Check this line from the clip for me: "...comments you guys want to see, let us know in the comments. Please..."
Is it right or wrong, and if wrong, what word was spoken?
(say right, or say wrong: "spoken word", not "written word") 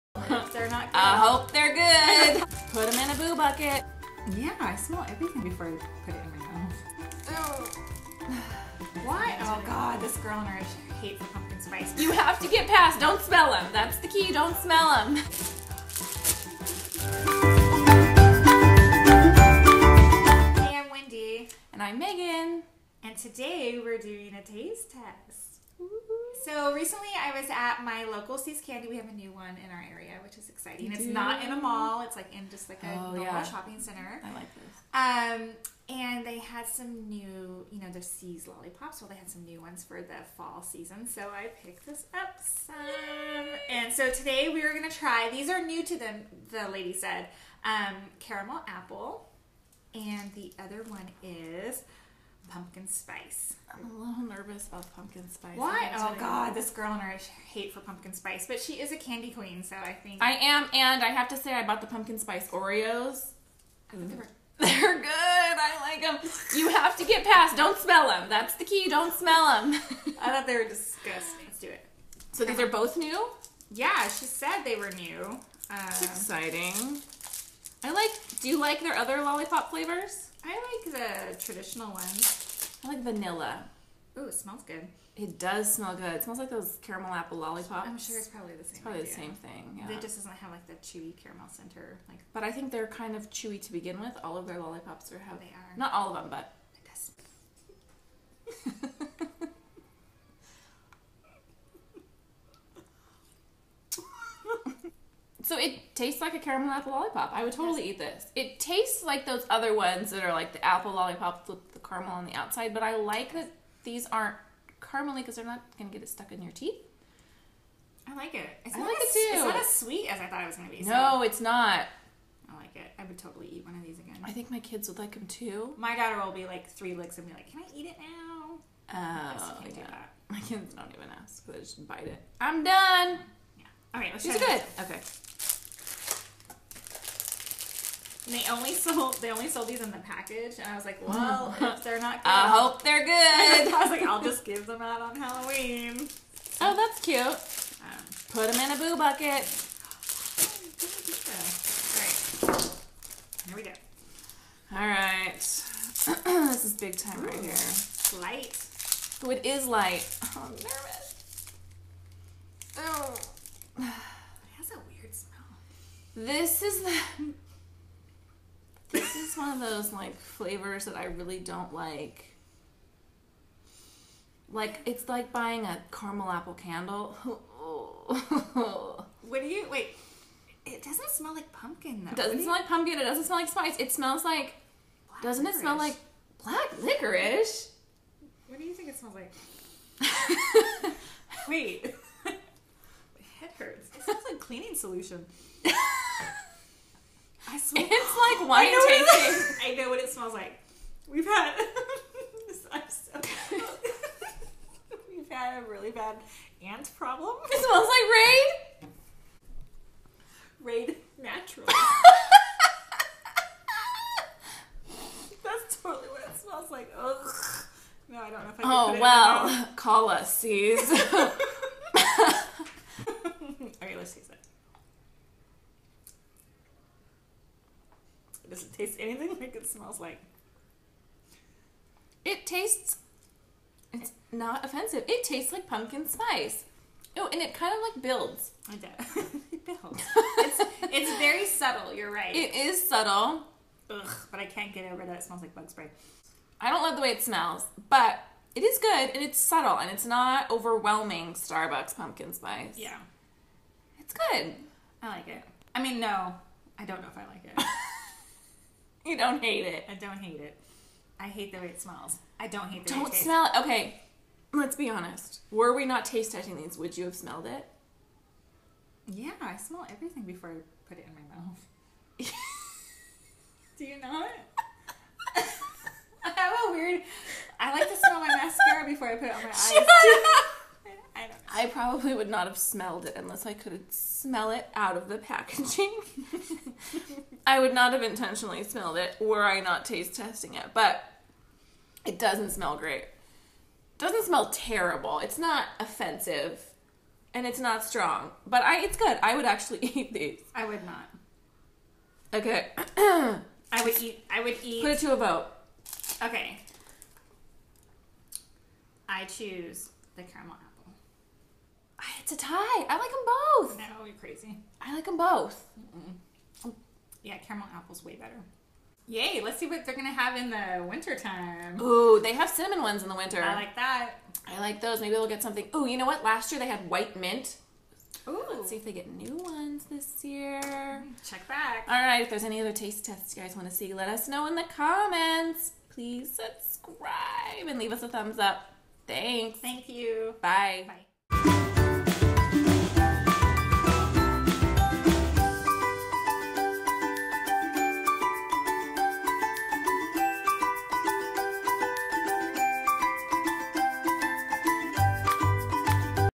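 wrong: "tests", not "comments".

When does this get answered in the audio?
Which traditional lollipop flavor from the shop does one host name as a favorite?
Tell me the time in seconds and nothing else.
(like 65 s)
83 s.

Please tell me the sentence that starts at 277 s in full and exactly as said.
I like to smell my mascara before I put it on my eyes.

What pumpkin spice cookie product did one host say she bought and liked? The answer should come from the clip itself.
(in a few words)
Pumpkin spice Oreos.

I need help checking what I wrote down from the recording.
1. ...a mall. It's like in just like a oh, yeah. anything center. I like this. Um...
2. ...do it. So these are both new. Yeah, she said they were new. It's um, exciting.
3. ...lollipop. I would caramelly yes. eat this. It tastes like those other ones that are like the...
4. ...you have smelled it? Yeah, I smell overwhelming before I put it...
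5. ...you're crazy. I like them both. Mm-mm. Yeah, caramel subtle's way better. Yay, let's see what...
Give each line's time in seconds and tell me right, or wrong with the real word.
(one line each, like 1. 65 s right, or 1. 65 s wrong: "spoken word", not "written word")
1. 31 s wrong: "shopping", not "anything"
2. 71 s right
3. 106 s wrong: "totally", not "caramelly"
4. 266 s wrong: "everything", not "overwhelming"
5. 314 s wrong: "apple", not "subtle".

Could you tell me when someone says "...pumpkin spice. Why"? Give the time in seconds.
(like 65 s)
54 s.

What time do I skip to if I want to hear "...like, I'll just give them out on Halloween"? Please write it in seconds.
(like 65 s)
143 s.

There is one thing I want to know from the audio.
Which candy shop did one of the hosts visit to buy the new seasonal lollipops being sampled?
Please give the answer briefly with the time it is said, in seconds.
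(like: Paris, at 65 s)
See's Candy, at 28 s.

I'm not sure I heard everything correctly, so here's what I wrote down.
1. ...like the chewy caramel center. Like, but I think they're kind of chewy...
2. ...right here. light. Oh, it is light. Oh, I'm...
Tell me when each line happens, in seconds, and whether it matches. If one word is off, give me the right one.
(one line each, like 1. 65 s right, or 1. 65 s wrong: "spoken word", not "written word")
1. 90 s right
2. 157 s right.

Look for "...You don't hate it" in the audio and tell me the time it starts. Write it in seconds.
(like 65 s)
259 s.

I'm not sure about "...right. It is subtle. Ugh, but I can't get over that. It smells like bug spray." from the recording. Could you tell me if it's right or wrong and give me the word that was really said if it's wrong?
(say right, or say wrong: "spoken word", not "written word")
right.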